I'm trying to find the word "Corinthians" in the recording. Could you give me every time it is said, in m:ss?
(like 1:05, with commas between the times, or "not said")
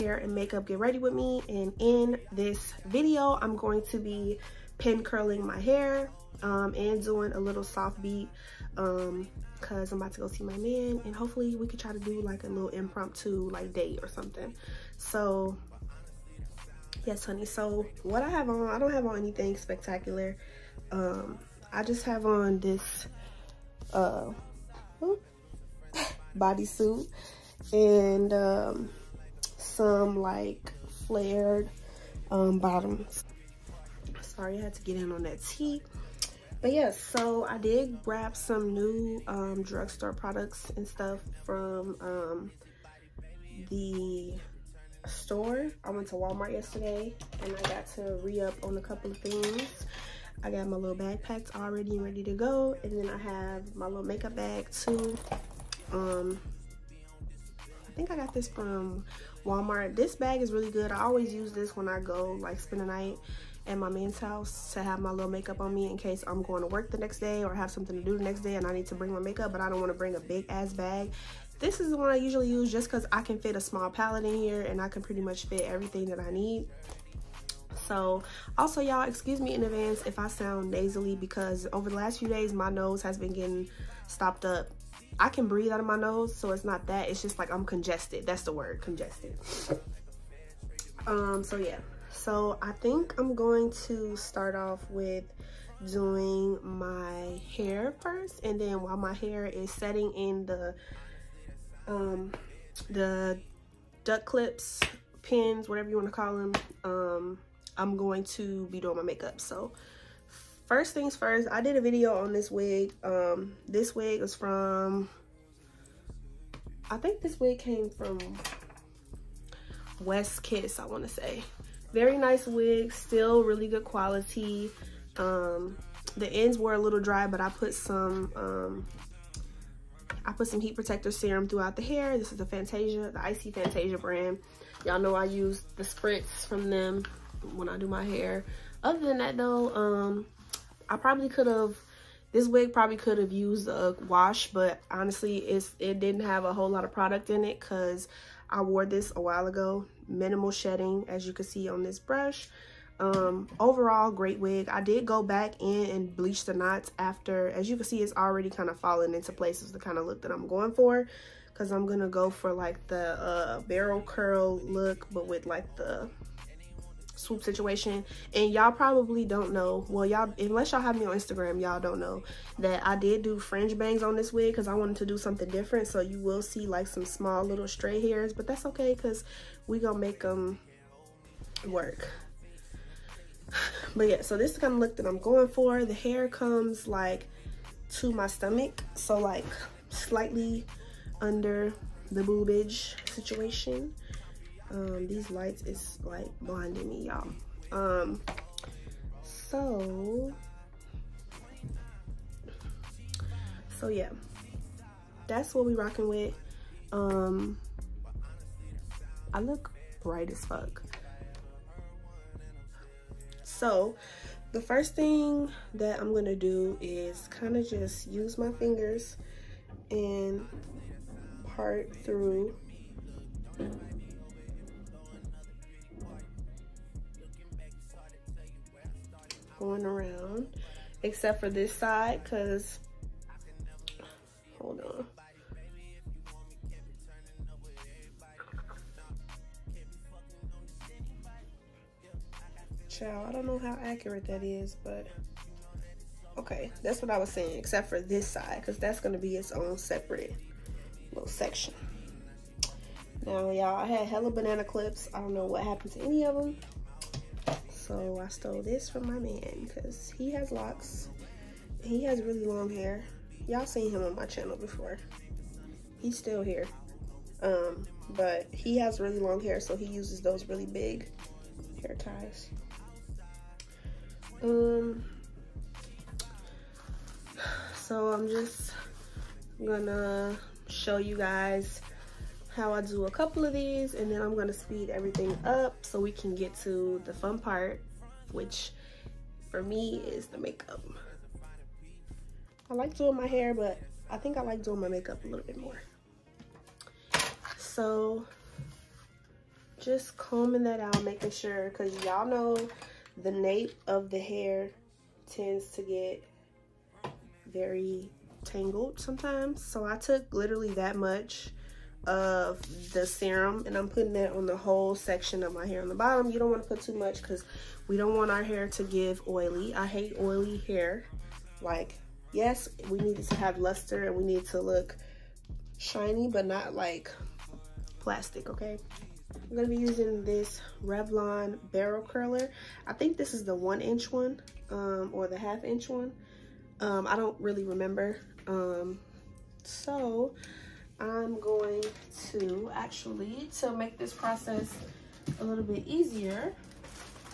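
not said.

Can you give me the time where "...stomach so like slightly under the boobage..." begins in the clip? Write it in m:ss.
3:08.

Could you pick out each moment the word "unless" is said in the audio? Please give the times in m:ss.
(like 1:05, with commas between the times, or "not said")
2:50.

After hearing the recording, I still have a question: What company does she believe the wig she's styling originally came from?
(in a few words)
West Kiss.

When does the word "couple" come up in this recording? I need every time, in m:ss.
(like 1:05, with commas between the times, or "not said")
0:48, 4:43.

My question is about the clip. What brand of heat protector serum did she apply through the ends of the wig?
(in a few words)
IC Fantasia.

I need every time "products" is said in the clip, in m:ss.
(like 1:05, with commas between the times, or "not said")
0:40, 2:26.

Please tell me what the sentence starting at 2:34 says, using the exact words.
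I did go back in and bleach the knots after.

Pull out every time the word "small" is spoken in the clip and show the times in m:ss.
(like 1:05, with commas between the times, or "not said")
1:13, 2:57.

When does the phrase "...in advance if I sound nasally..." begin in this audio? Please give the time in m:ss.
1:19.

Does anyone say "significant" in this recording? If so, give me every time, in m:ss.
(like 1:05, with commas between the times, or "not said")
not said.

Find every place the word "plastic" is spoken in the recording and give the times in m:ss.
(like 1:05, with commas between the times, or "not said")
5:27.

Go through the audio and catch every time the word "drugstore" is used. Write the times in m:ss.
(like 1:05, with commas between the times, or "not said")
0:39.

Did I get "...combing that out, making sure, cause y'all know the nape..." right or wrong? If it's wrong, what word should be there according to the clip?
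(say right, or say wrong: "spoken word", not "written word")
right.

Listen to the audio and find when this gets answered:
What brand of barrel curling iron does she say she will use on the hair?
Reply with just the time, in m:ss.
5:30.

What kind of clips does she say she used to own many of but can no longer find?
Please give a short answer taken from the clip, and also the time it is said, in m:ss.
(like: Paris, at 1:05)
banana clips, at 4:14.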